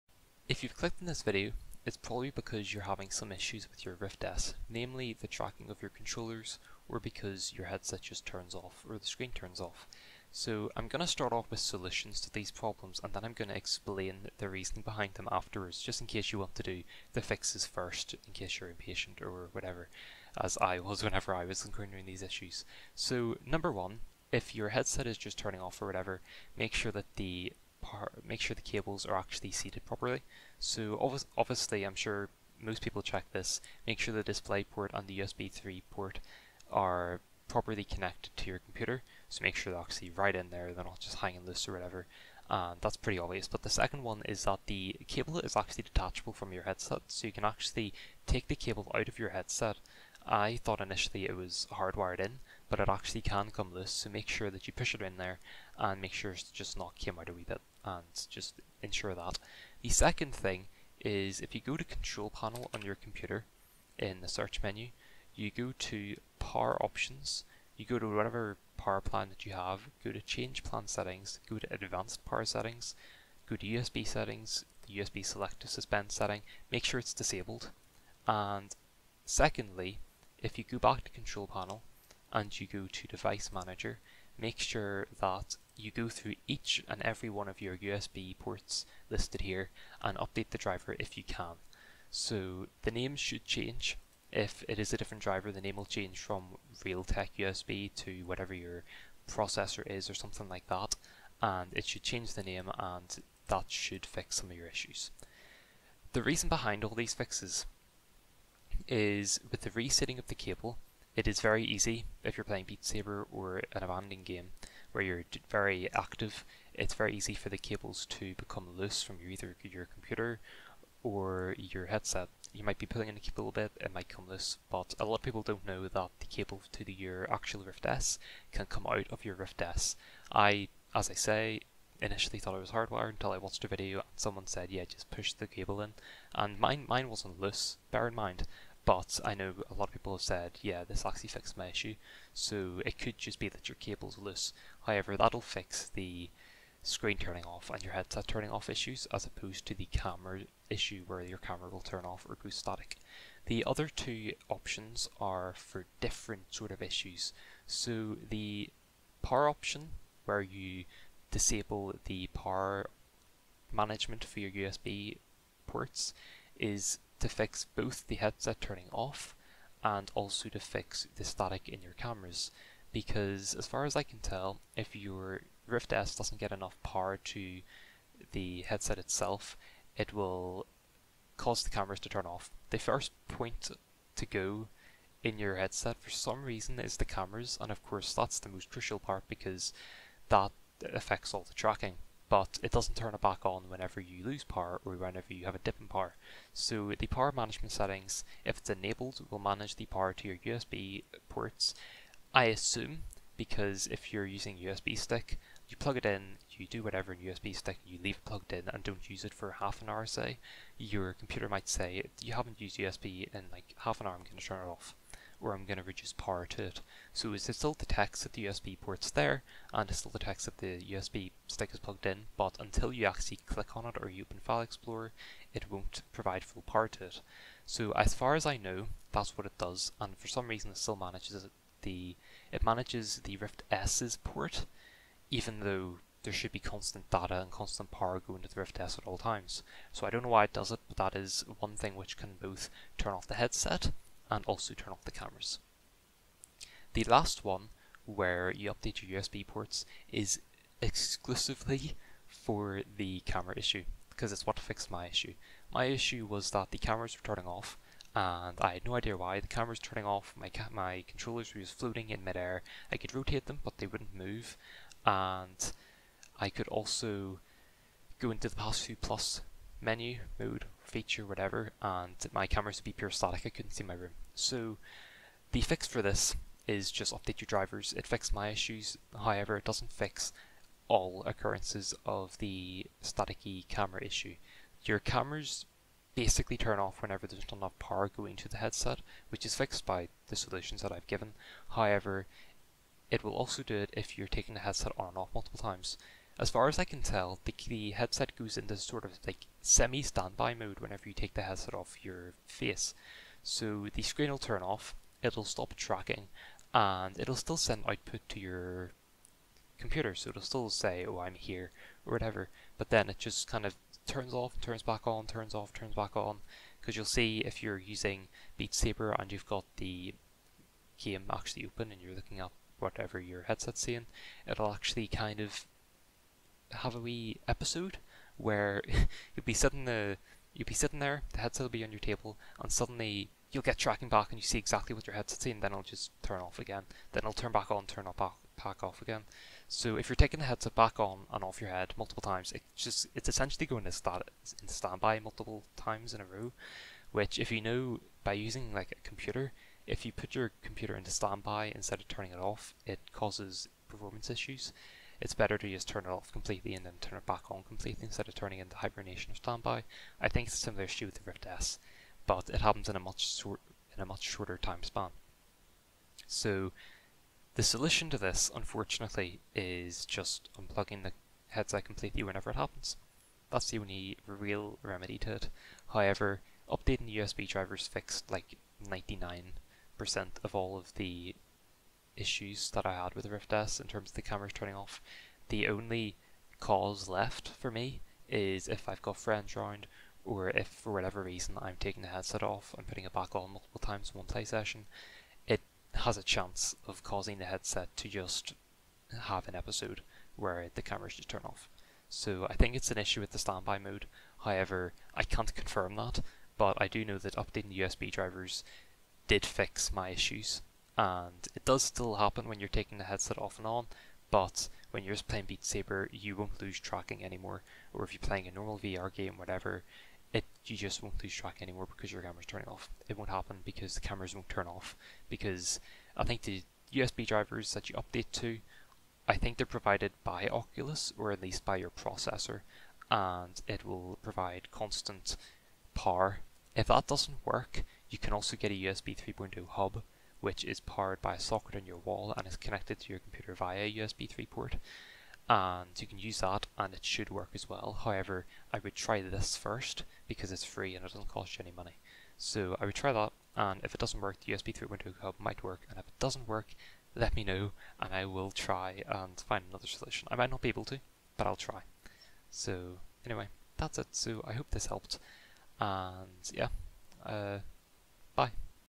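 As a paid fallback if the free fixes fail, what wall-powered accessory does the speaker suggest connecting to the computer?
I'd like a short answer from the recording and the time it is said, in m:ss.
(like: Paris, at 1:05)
USB 3.0 hub, at 7:18.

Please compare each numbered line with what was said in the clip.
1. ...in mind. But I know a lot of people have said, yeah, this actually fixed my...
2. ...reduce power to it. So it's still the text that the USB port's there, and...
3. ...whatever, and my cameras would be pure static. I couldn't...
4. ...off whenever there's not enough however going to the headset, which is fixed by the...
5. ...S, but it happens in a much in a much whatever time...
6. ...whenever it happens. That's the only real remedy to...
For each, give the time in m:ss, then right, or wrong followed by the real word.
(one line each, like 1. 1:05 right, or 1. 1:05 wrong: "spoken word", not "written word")
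1. 2:18 right
2. 3:35 right
3. 4:31 right
4. 4:46 wrong: "power", not "however"
5. 6:01 wrong: "shorter", not "whatever"
6. 6:12 right.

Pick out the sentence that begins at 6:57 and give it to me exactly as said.
Or if you're playing a normal VR game, whatever, it you just won't lose track anymore because your camera's turning off.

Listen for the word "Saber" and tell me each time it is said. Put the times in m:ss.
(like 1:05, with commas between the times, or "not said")
1:52, 5:18, 6:55.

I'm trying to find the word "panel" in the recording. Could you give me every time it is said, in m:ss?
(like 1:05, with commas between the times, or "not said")
1:02, 1:21.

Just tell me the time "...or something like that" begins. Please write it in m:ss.
1:40.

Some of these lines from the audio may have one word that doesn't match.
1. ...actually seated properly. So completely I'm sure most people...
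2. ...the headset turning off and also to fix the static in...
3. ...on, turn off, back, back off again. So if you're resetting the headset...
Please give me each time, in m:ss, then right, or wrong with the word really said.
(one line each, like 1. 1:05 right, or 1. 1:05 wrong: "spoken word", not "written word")
1. 0:29 wrong: "obviously", not "completely"
2. 2:48 right
3. 5:37 wrong: "taking", not "resetting".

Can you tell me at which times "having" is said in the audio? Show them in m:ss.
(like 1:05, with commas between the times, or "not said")
0:02.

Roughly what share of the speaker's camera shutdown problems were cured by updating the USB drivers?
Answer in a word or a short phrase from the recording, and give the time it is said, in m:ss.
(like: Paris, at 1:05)
99%, at 6:18.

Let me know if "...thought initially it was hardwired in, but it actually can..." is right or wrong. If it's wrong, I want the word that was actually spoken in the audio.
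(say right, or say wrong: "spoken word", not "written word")
right.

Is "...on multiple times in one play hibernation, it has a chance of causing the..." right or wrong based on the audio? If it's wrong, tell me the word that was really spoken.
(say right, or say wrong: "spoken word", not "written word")
wrong: "session", not "hibernation".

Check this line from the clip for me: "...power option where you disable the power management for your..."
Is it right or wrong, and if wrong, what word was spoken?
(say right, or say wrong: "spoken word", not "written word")
right.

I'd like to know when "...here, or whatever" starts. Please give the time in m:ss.
5:11.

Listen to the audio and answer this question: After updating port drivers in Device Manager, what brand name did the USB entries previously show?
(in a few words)
Realtek.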